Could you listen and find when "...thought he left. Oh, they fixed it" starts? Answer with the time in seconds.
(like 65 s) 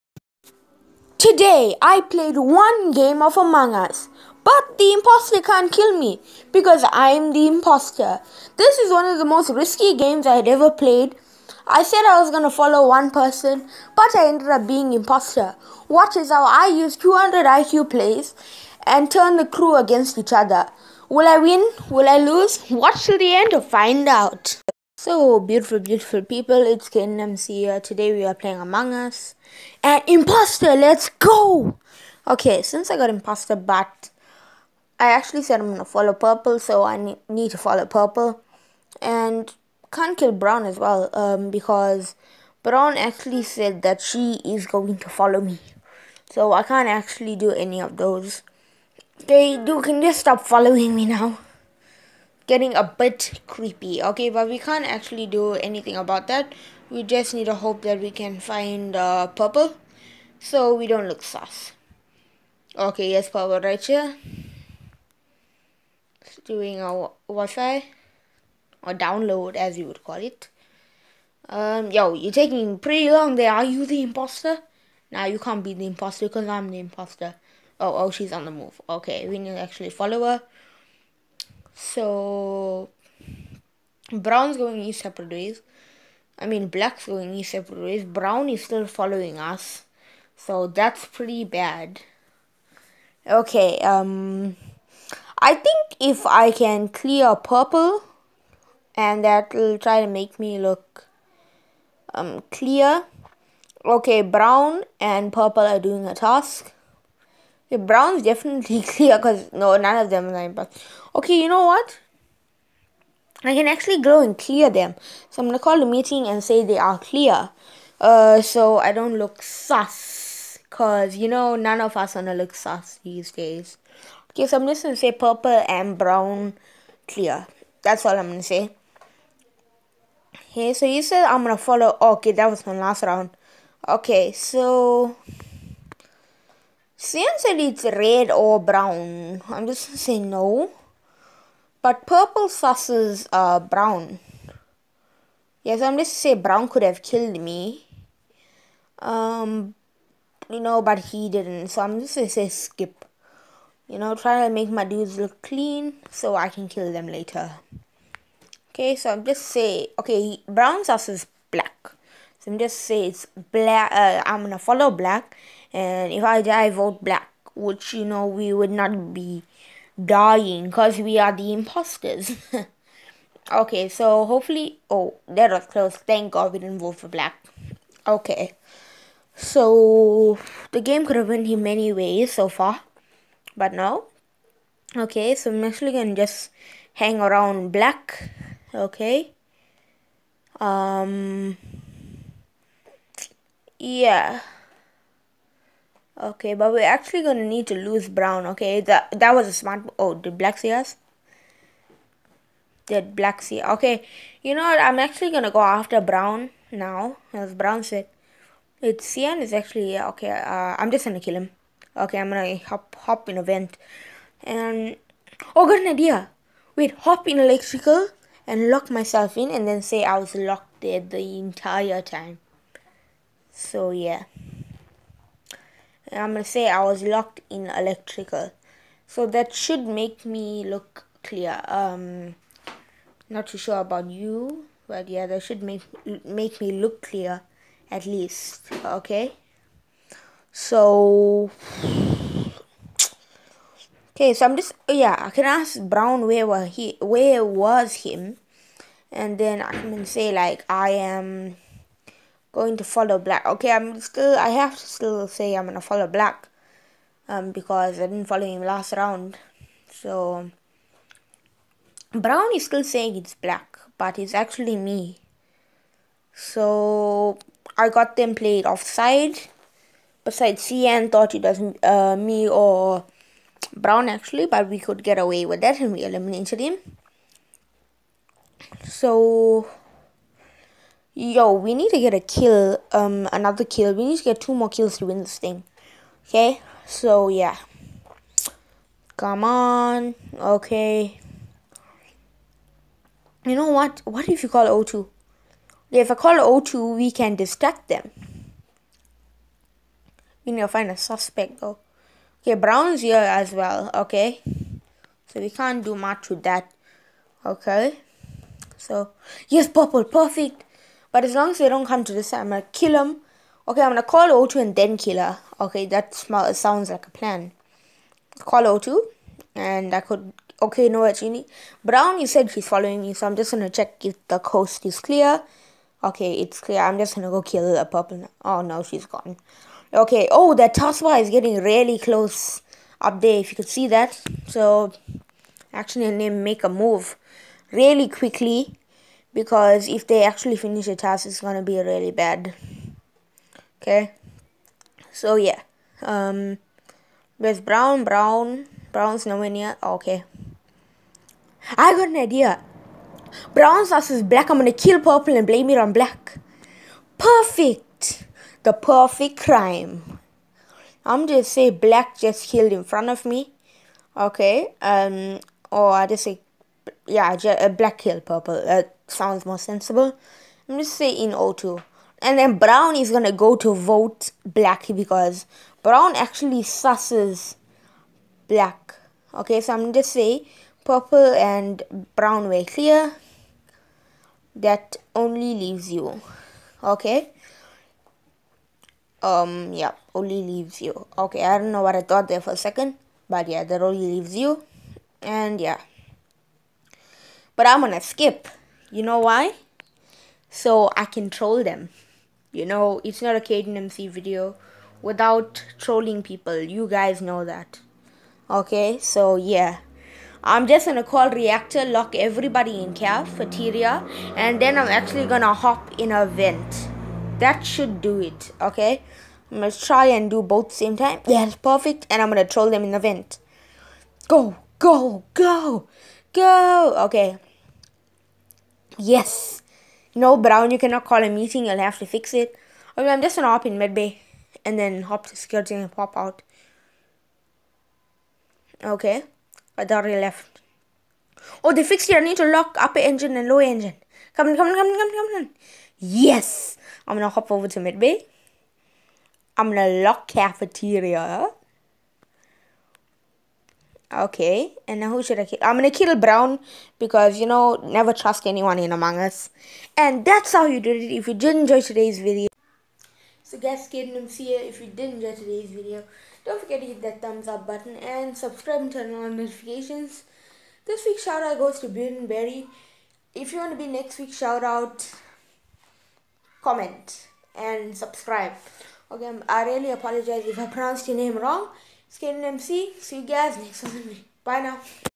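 439 s.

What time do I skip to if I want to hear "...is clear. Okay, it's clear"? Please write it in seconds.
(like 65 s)
324 s.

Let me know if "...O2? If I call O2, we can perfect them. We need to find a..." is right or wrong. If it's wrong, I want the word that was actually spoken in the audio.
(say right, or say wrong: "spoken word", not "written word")
wrong: "distract", not "perfect".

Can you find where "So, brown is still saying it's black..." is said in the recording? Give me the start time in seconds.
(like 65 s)
259 s.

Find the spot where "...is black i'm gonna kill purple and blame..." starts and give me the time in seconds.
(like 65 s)
354 s.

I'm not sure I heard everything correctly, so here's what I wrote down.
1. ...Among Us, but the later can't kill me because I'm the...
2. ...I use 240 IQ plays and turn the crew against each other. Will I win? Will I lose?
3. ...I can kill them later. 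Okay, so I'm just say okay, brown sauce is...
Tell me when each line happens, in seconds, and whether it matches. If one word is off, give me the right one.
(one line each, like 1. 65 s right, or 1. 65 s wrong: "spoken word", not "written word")
1. 3 s wrong: "imposter", not "later"
2. 16 s wrong: "200", not "240"
3. 156 s right.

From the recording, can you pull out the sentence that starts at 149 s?
Um, you know, but he didn't.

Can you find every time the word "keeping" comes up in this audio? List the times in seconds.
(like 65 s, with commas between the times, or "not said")
not said.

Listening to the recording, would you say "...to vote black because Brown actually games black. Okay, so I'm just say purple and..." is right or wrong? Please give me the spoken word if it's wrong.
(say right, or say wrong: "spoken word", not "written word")
wrong: "susses", not "games".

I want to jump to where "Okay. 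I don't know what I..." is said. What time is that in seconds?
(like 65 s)
391 s.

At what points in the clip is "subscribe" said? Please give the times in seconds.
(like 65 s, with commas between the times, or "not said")
468 s, 477 s.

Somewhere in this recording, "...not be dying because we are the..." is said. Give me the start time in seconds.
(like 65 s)
168 s.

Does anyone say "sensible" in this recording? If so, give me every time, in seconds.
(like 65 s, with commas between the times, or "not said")
369 s.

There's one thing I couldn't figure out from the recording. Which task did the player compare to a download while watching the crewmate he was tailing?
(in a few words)
Wi-fi.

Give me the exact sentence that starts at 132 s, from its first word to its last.
Okay, that was my last round.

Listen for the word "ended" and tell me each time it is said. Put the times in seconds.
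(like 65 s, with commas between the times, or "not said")
14 s.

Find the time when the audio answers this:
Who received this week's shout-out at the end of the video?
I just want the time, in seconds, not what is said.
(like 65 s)
471 s.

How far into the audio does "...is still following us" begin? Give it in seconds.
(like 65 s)
88 s.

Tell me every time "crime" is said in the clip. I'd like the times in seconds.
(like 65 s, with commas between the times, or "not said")
359 s.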